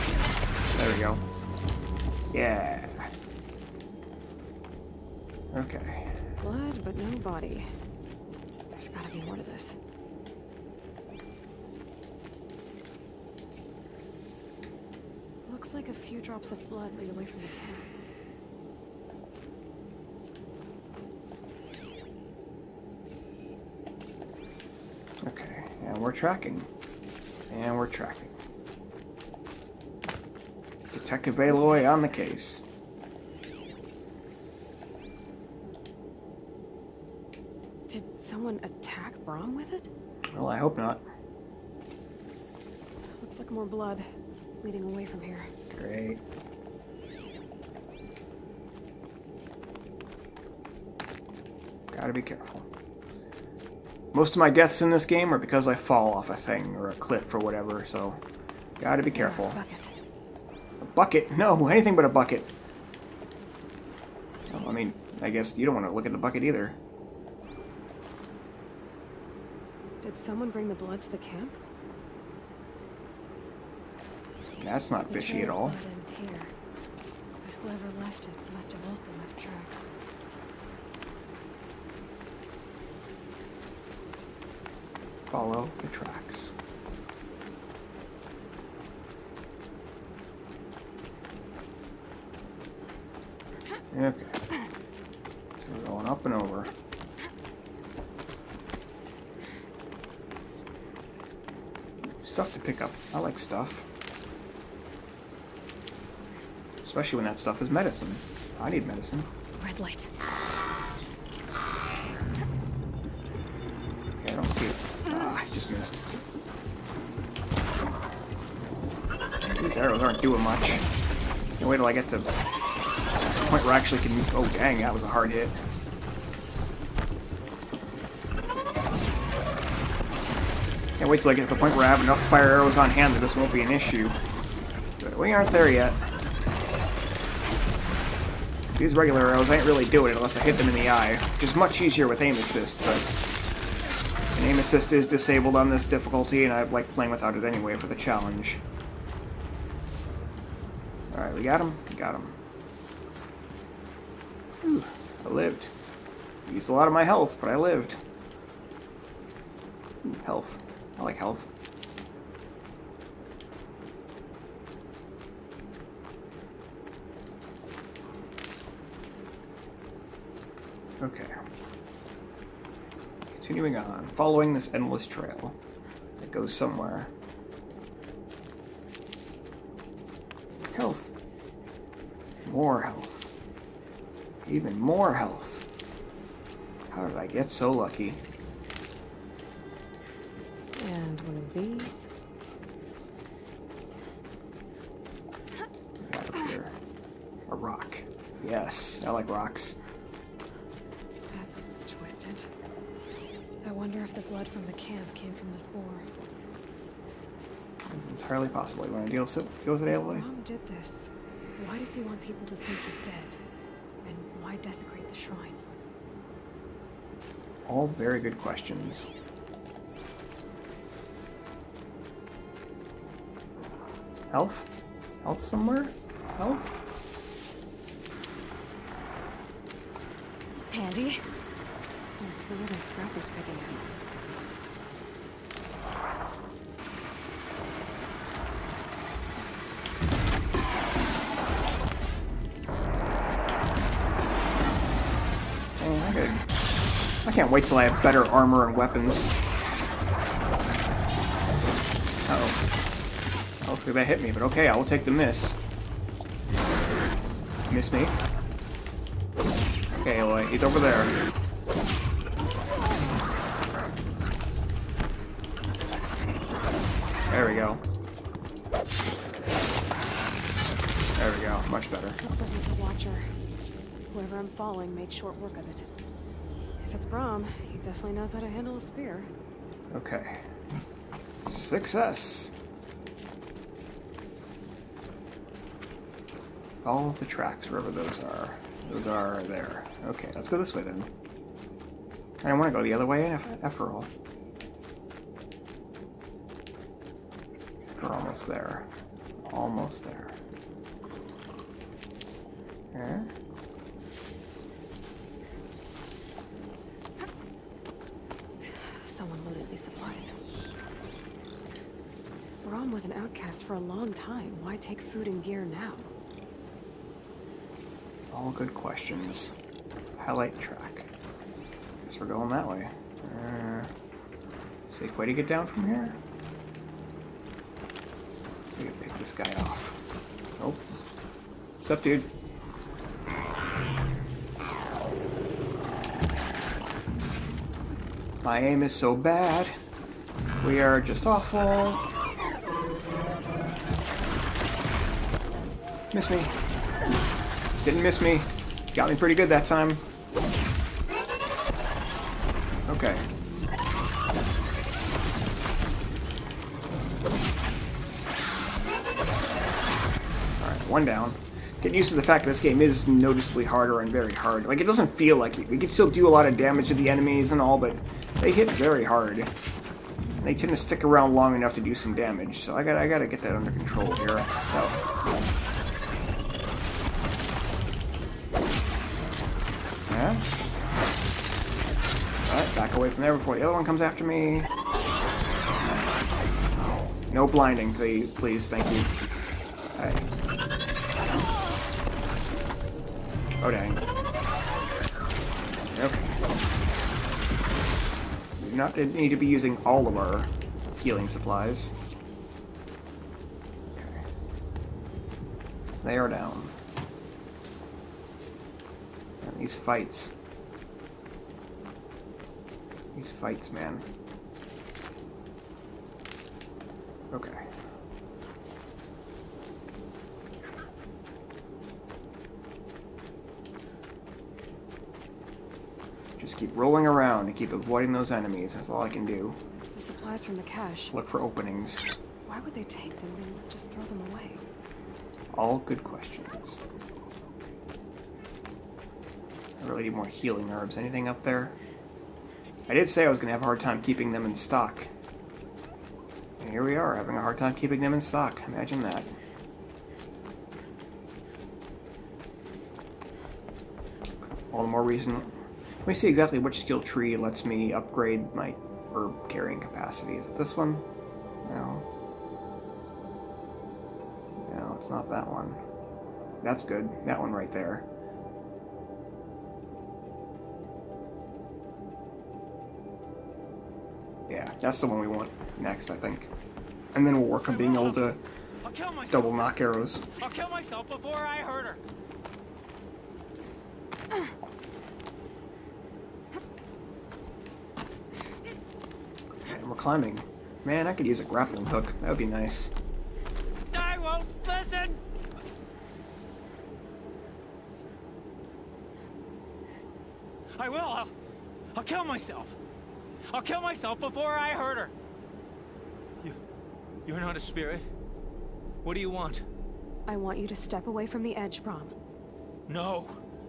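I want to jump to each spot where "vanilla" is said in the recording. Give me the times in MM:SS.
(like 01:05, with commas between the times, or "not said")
not said.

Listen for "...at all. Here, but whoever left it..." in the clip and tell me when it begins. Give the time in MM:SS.
01:15.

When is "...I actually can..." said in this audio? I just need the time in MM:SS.
02:03.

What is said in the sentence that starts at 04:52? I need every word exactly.
I don't want to go the other way after all.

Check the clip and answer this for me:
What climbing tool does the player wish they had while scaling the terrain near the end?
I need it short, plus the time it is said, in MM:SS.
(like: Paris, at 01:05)
A grappling hook, at 08:11.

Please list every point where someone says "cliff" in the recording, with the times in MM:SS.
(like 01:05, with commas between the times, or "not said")
00:56.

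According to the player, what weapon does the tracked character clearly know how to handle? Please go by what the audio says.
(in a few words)
A spear.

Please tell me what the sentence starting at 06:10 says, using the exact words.
They tend to stick around long enough to do some damage, so I gotta, I gotta get that under control here.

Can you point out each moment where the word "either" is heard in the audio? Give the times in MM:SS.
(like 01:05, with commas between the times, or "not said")
01:06.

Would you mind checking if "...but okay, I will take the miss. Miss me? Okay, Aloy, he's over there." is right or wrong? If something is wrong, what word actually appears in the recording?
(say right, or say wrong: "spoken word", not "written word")
right.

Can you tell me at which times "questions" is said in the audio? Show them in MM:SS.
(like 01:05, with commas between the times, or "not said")
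03:38, 05:18, 07:16.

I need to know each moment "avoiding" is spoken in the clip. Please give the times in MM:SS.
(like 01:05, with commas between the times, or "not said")
07:07.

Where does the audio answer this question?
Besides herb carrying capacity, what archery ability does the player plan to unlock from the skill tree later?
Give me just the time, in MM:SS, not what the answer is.
07:59.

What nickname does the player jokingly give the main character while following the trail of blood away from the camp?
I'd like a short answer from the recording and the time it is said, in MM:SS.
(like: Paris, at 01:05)
Detective Aloy, at 00:30.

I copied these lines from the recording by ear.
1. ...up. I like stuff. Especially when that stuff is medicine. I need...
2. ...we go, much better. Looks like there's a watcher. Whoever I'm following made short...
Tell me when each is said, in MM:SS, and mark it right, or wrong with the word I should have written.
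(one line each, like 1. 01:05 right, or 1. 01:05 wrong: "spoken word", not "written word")
1. 01:42 right
2. 04:31 right.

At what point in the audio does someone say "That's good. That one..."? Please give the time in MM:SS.
07:46.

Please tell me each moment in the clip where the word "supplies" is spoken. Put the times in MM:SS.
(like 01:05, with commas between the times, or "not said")
05:09, 06:41, 07:10.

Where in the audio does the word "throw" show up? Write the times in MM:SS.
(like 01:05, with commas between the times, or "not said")
07:13.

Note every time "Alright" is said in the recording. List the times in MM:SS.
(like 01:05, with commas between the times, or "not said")
02:31, 06:00, 06:22.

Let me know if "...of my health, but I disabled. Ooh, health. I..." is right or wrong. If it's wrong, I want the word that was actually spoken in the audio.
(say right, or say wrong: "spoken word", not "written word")
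wrong: "lived", not "disabled".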